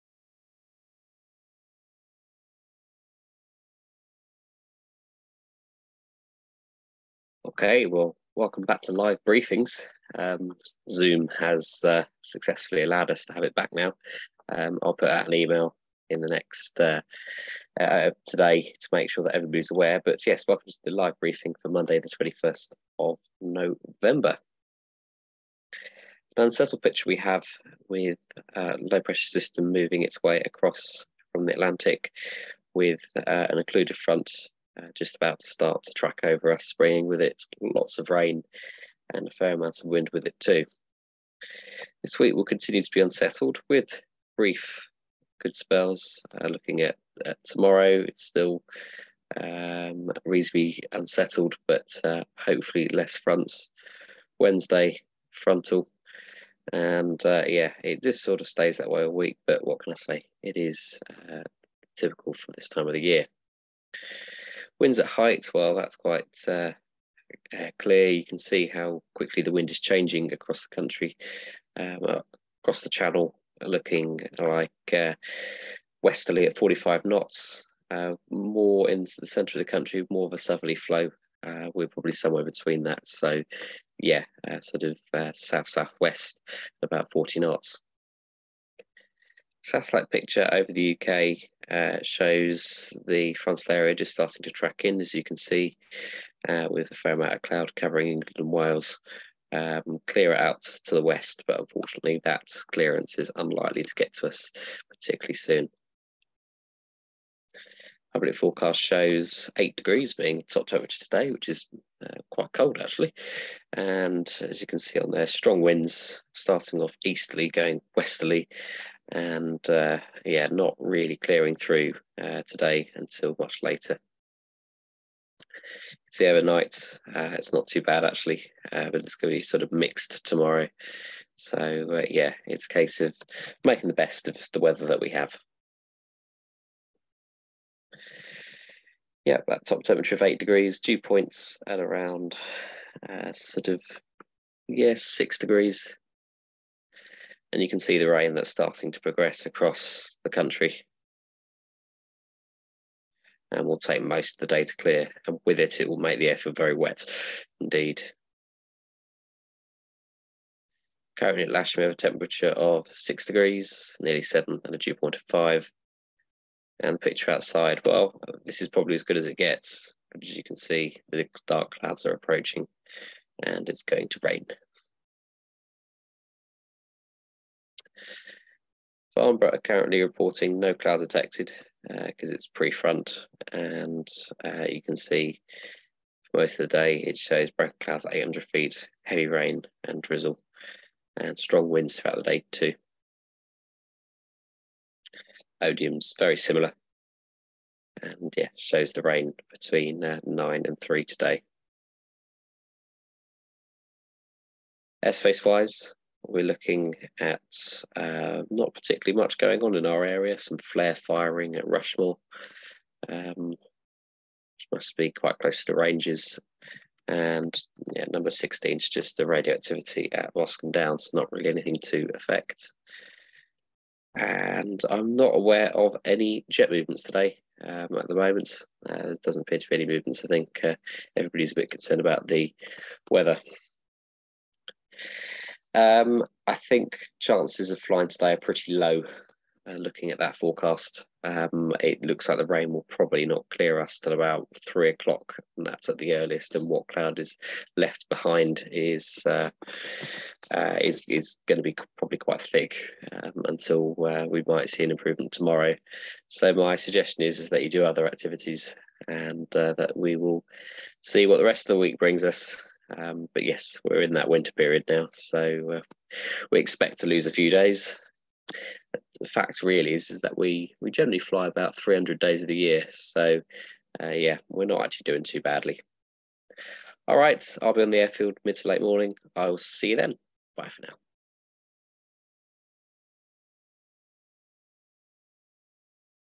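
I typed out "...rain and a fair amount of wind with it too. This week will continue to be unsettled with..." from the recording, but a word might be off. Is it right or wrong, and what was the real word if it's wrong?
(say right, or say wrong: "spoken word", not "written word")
right.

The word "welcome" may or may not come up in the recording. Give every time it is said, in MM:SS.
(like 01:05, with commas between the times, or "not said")
00:08, 00:20.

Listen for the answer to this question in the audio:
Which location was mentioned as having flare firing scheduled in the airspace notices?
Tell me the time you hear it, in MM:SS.
03:31.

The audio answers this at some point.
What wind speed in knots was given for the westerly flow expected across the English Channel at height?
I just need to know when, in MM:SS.
01:16.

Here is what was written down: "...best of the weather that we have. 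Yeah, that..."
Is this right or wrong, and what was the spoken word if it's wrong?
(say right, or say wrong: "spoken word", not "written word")
right.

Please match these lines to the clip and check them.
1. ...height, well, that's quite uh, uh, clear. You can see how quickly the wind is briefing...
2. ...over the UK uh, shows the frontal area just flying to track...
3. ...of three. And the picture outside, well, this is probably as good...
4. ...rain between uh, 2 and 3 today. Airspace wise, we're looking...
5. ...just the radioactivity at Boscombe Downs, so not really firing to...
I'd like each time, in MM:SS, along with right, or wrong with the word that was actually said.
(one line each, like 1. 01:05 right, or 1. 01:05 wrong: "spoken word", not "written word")
1. 01:05 wrong: "changing", not "briefing"
2. 01:30 wrong: "starting", not "flying"
3. 02:45 wrong: "five", not "three"
4. 03:19 wrong: "9", not "2"
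5. 03:38 wrong: "anything", not "firing".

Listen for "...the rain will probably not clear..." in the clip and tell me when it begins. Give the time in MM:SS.
04:02.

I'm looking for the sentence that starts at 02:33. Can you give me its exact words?
And will take most of the day to clear, and with it, it will make the air feel very wet indeed.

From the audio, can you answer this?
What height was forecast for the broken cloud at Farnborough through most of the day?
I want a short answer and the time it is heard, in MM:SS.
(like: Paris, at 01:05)
800 feet, at 03:08.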